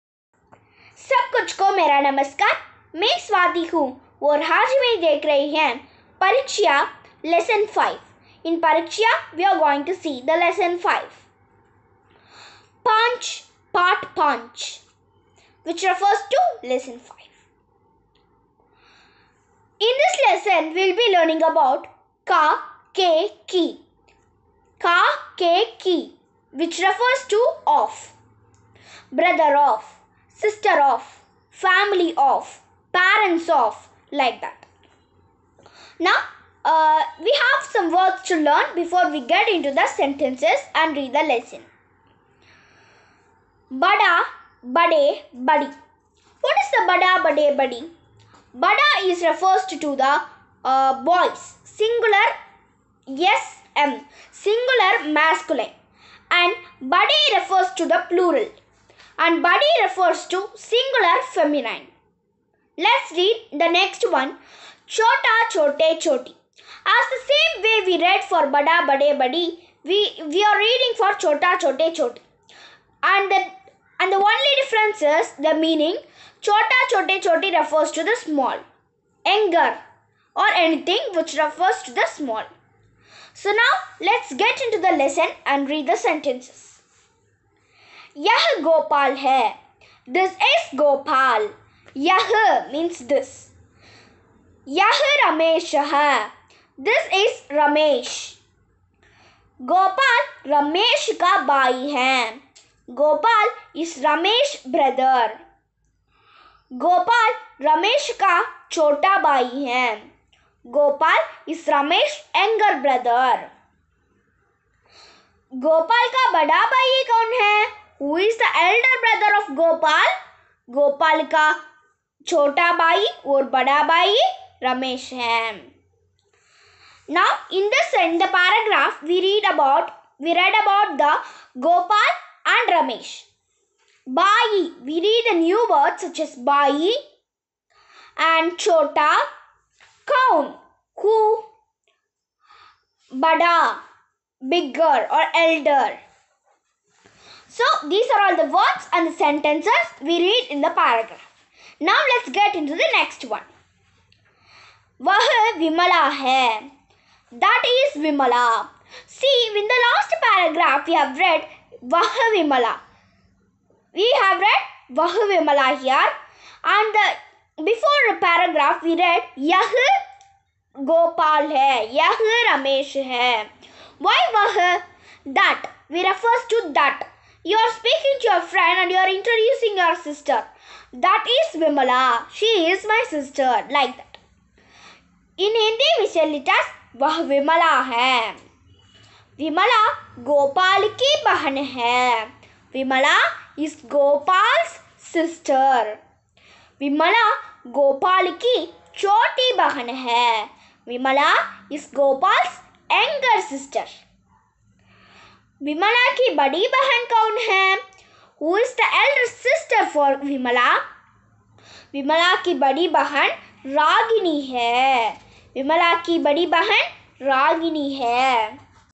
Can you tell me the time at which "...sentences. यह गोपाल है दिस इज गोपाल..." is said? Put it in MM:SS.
01:25.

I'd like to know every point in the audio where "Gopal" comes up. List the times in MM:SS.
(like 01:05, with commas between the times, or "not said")
01:59, 02:11.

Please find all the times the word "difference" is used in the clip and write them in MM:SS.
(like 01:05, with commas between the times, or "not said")
01:14.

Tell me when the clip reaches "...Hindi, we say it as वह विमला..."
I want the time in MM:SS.
03:05.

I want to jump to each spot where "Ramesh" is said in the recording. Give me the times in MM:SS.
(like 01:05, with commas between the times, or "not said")
02:04, 02:12.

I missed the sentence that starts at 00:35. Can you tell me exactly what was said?
Now, uh, we have some words to learn before we get into the sentences and read the lesson.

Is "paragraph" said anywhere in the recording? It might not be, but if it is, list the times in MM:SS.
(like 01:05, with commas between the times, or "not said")
02:08, 02:30, 02:40, 02:48.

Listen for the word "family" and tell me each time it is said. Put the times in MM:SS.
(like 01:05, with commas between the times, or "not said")
00:31.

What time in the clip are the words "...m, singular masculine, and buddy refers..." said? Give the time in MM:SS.
00:53.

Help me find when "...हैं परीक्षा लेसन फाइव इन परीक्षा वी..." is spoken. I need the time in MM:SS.
00:05.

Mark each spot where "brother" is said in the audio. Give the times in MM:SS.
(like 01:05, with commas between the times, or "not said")
01:59.